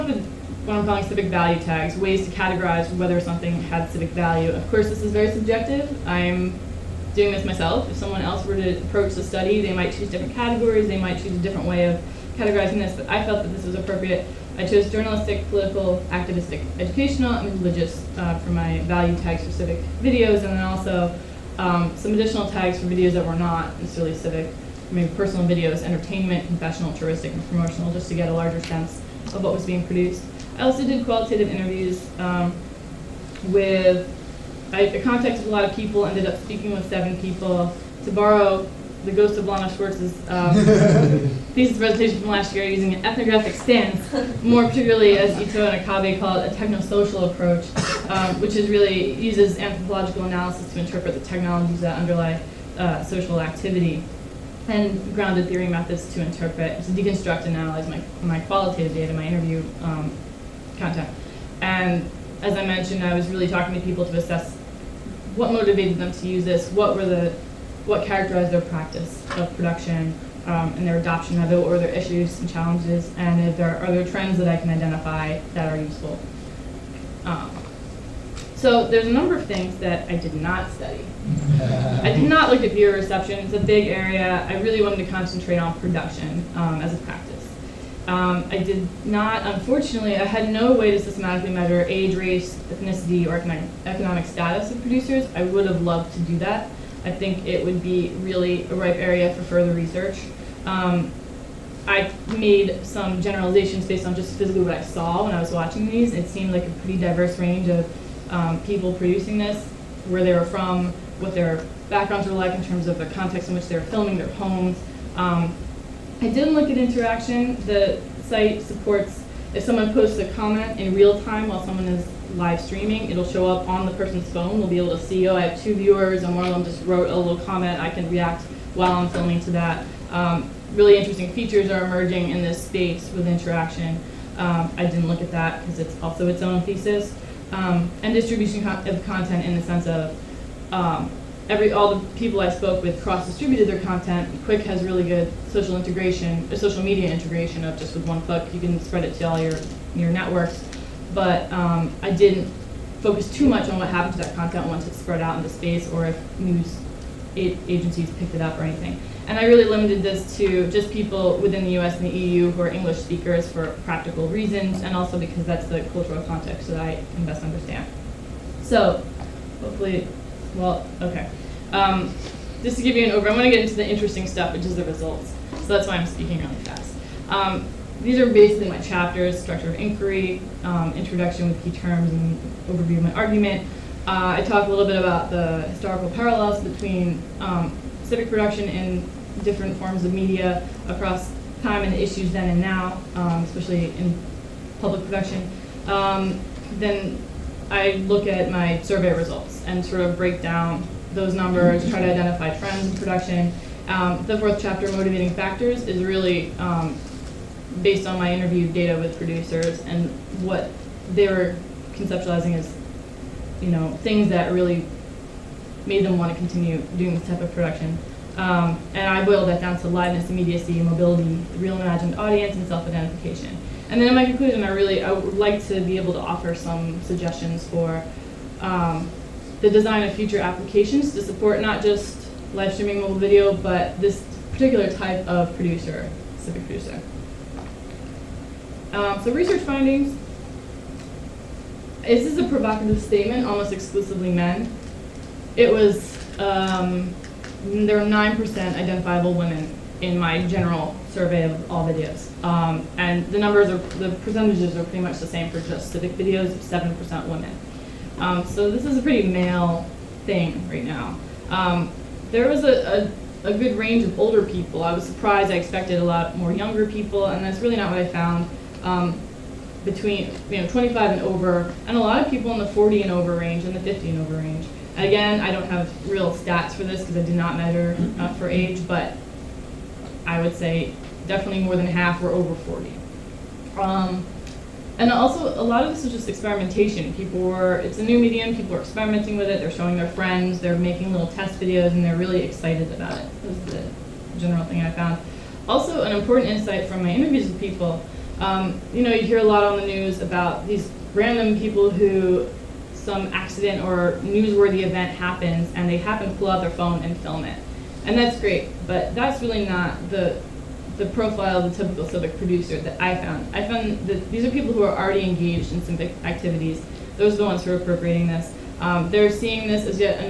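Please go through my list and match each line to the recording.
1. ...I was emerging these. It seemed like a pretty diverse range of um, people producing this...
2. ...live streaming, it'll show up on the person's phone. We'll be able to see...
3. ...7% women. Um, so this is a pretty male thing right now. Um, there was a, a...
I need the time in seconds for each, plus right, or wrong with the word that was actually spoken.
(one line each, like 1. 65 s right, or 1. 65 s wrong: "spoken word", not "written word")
1. 105 s wrong: "watching", not "emerging"
2. 122 s right
3. 256 s right.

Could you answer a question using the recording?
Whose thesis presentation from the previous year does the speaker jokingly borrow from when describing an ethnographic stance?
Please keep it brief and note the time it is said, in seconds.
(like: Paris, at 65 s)
Lana Swartz, at 39 s.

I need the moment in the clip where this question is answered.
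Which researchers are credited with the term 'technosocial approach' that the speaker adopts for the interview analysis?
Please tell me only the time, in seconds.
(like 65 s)
45 s.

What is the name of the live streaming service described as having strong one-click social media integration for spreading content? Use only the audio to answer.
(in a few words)
Qik.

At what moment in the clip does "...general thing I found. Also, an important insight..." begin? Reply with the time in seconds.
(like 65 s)
294 s.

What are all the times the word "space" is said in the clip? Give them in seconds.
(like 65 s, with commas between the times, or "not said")
132 s, 155 s.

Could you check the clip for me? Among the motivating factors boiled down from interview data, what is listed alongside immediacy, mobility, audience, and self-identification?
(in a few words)
liveness.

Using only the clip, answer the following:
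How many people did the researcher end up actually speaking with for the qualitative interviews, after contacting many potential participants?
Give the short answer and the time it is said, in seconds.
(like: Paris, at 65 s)
7, at 36 s.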